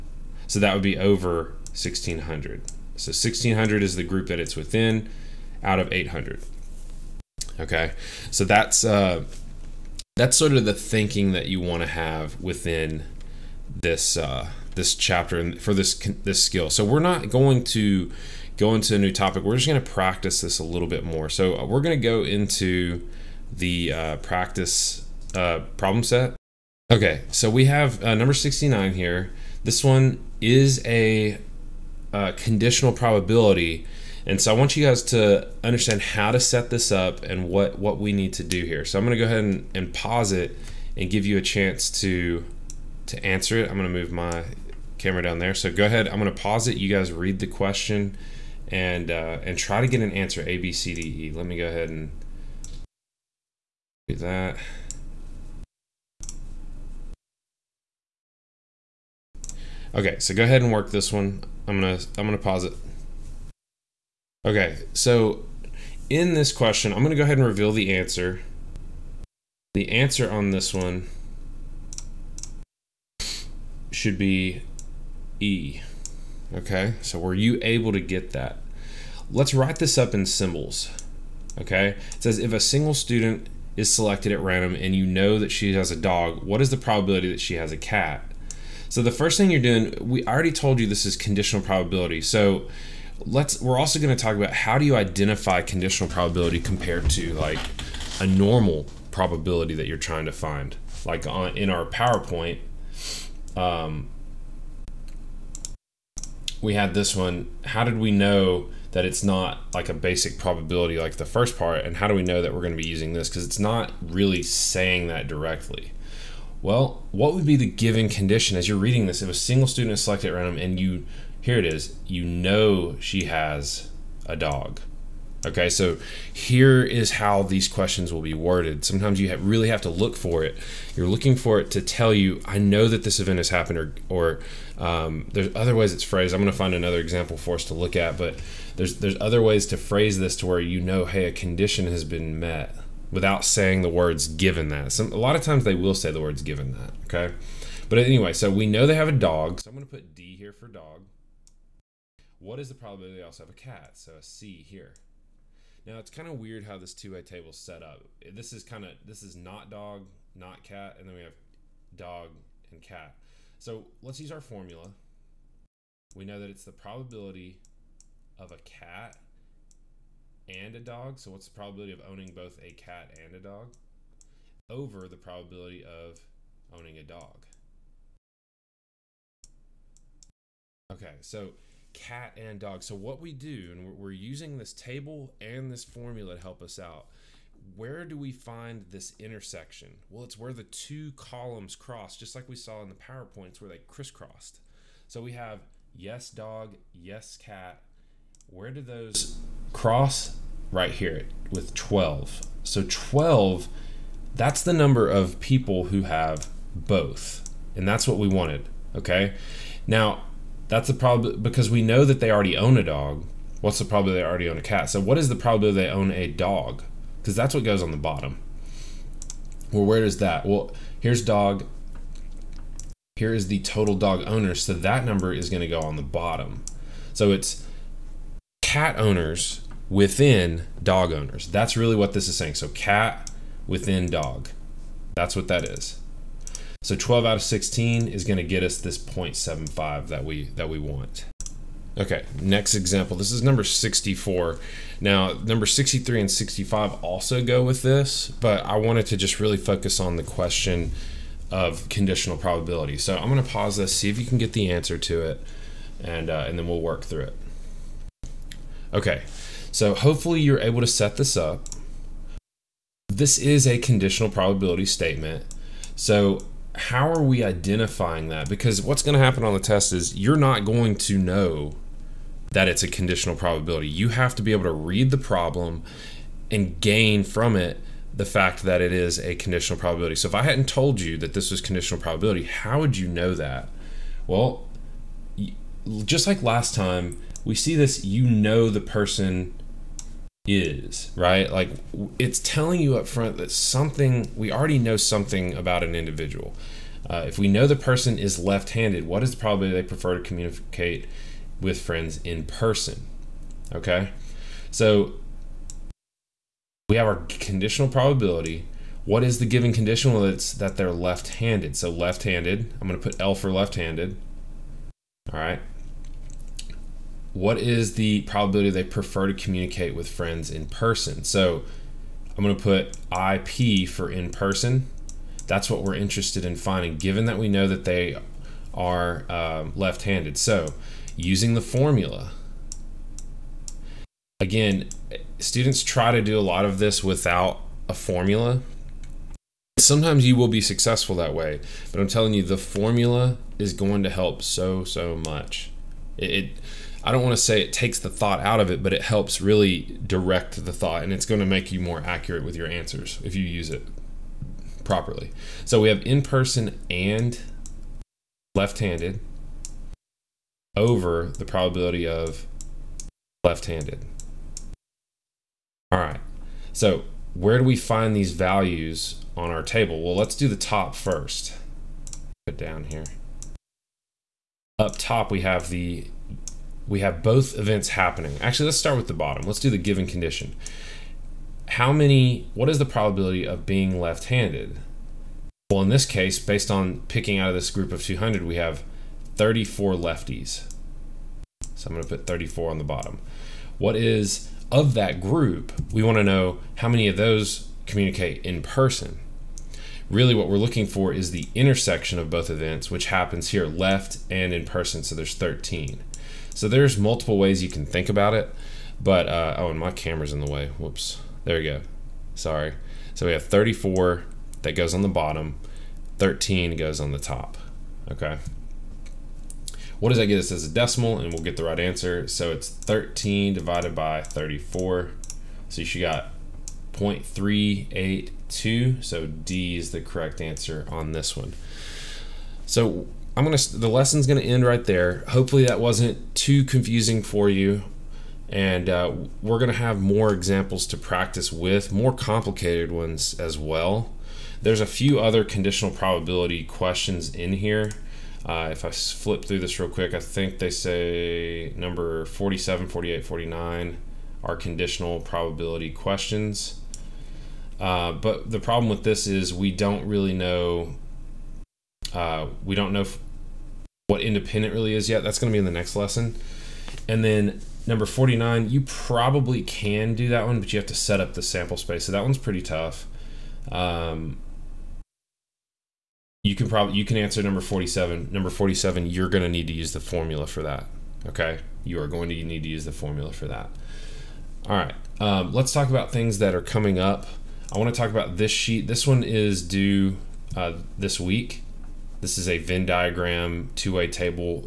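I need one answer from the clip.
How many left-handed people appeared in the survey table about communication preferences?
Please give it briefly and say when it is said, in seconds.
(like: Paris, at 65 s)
34, at 388 s.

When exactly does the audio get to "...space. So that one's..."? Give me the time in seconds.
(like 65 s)
471 s.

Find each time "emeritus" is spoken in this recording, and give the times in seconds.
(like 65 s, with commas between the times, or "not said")
not said.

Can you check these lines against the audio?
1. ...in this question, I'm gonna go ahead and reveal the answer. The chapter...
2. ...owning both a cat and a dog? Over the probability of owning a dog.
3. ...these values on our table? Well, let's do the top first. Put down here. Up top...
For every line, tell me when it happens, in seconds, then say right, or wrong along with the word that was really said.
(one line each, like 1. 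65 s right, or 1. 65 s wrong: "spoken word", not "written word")
1. 66 s wrong: "answer", not "chapter"
2. 172 s right
3. 368 s right.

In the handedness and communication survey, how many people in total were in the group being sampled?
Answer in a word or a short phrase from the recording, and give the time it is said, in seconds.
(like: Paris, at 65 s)
200, at 387 s.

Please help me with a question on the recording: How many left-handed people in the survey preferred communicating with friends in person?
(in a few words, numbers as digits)
13.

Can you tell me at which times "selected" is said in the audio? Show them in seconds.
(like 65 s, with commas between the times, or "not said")
83 s, 120 s.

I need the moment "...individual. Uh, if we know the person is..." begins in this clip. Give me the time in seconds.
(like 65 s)
295 s.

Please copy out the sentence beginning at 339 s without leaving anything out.
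Sometimes you will be successful that way, but I'm telling you, the formula is going to help so, so much.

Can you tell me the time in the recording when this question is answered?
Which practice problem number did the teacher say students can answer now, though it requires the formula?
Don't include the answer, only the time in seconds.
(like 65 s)
478 s.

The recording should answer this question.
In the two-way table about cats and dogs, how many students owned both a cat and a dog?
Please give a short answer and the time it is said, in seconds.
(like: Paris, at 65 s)
12, at 200 s.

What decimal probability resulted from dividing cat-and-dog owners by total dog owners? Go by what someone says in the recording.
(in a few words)
0.75.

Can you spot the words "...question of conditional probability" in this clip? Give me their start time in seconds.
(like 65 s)
250 s.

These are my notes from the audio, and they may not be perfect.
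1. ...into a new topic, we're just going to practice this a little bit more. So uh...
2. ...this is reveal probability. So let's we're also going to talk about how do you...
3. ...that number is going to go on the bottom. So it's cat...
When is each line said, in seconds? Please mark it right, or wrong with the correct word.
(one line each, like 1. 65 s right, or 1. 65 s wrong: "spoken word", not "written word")
1. 18 s right
2. 90 s wrong: "conditional", not "reveal"
3. 224 s right.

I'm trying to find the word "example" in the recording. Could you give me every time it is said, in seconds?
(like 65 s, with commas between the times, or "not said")
136 s, 242 s, 440 s.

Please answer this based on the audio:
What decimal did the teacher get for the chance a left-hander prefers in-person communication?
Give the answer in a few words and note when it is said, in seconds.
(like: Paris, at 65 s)
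0.382, at 426 s.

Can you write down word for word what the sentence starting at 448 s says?
Uh, if I flip through this real quick, I think they say number 47, 48, 49 are conditional probability questions.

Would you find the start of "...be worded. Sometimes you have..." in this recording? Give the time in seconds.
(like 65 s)
128 s.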